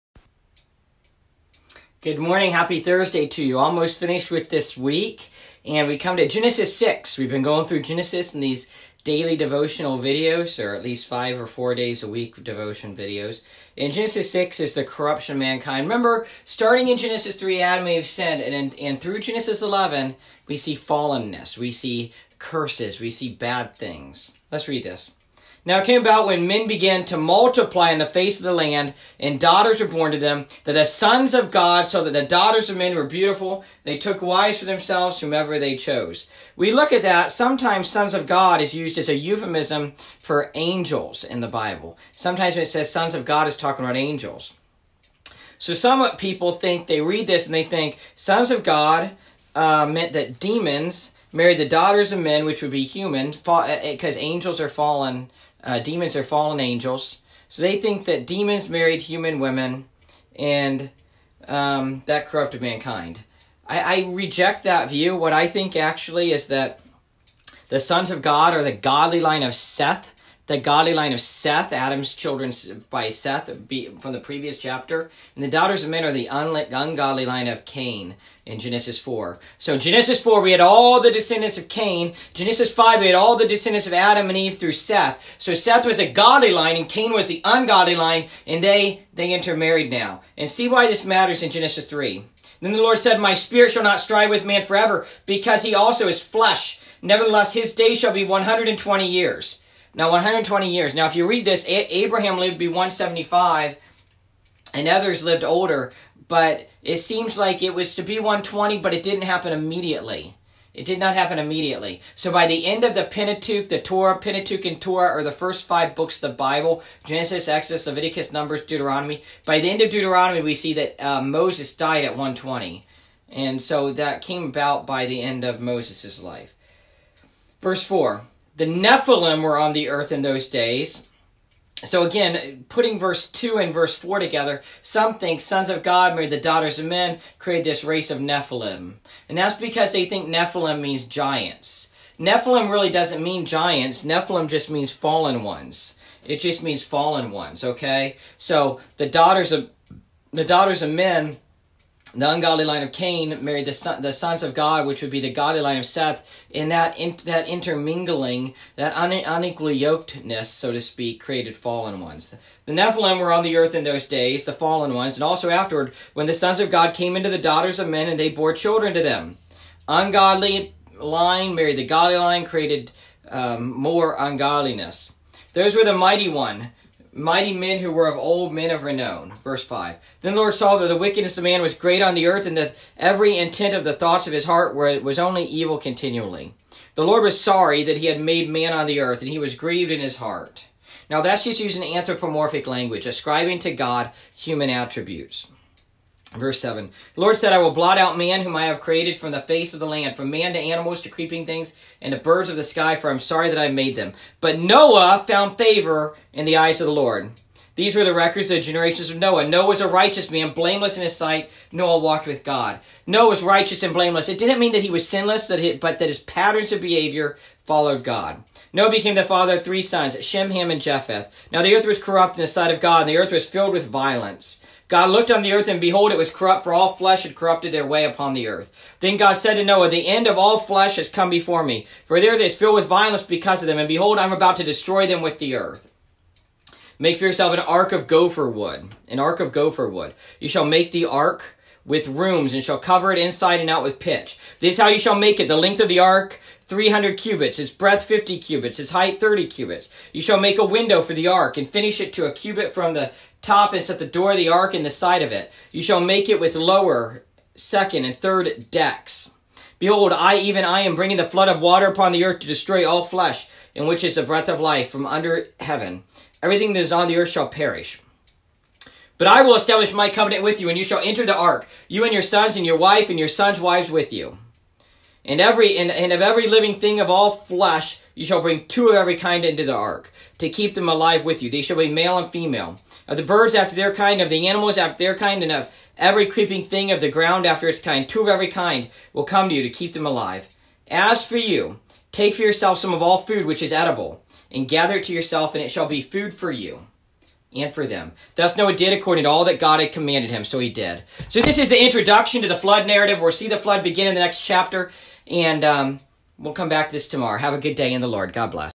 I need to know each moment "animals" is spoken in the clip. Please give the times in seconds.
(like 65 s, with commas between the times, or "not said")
200 s, 284 s.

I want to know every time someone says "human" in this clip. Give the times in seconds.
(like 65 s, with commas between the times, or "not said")
52 s, 59 s, 194 s.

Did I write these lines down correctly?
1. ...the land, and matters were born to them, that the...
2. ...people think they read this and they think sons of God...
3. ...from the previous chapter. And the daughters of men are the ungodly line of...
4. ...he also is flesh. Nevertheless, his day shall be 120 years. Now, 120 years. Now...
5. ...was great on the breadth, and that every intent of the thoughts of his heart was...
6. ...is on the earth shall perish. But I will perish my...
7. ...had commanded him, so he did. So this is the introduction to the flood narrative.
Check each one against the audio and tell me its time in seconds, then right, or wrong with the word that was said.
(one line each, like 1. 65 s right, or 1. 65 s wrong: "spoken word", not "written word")
1. 28 s wrong: "daughters", not "matters"
2. 46 s right
3. 73 s right
4. 95 s right
5. 181 s wrong: "earth", not "breadth"
6. 266 s wrong: "establish", not "perish"
7. 299 s right.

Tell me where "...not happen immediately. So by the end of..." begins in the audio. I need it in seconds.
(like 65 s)
110 s.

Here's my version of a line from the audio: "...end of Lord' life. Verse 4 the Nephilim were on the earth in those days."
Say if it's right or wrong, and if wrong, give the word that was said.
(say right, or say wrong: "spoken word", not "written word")
wrong: "Moses", not "Lord".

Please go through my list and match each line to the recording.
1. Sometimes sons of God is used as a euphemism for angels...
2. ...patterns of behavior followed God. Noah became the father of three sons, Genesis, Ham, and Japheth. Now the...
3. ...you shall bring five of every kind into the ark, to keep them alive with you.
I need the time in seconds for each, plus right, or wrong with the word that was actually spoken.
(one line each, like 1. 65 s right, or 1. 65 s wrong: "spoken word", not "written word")
1. 37 s right
2. 216 s wrong: "Shem", not "Genesis"
3. 278 s wrong: "two", not "five".